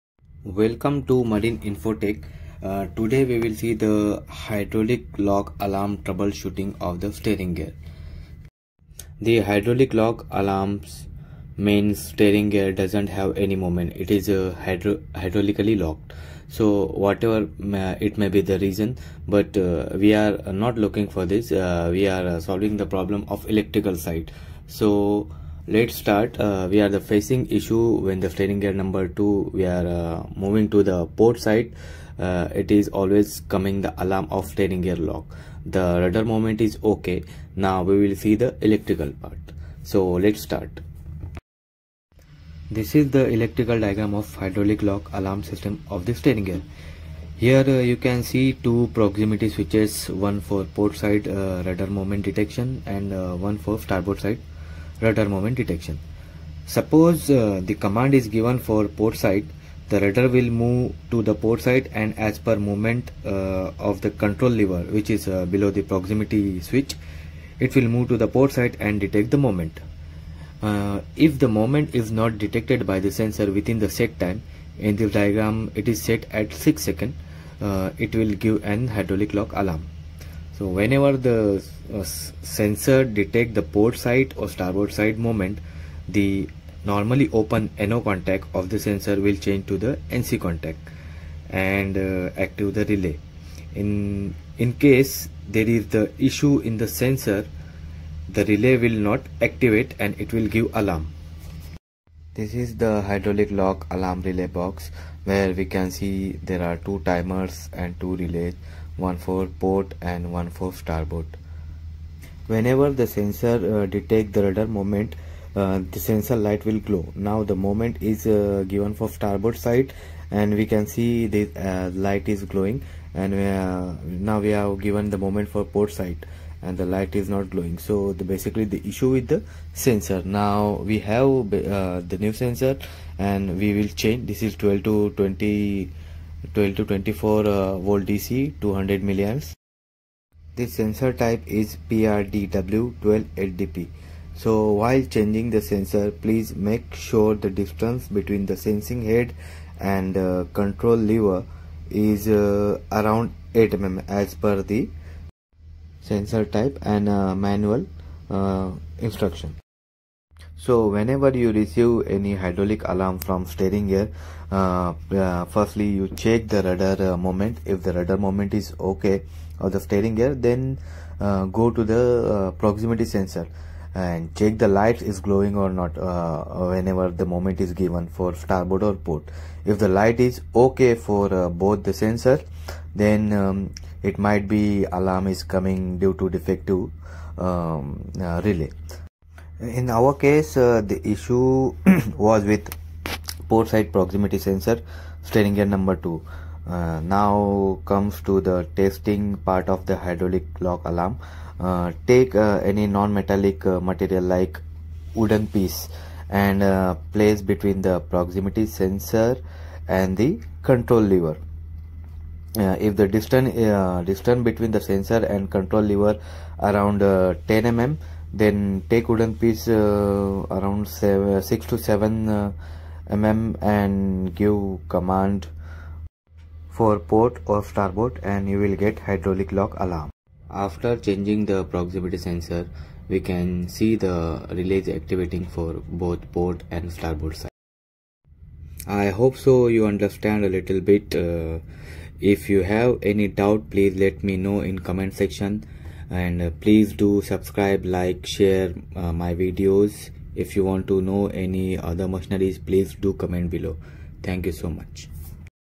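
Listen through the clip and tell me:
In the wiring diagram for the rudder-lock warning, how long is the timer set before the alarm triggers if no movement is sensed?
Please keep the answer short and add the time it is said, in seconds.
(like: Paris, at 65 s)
6 seconds, at 76 s.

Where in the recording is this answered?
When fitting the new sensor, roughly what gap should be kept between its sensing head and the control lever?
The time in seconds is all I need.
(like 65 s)
153 s.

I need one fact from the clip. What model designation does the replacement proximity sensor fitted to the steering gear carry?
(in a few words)
PRDW12LDP.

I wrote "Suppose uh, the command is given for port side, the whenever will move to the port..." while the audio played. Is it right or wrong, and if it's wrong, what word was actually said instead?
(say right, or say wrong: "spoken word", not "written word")
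wrong: "rudder", not "whenever".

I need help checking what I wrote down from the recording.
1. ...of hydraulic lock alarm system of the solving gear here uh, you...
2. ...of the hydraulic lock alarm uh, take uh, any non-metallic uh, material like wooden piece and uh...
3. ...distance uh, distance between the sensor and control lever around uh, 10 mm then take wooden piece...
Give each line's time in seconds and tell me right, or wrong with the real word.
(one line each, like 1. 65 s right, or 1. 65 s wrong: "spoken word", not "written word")
1. 44 s wrong: "steering", not "solving"
2. 199 s right
3. 213 s right.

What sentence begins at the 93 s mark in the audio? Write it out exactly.
In, in case there is the issue in the sensor, the relay will not activate and it will give alarm.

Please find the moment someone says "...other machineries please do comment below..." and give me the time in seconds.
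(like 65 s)
251 s.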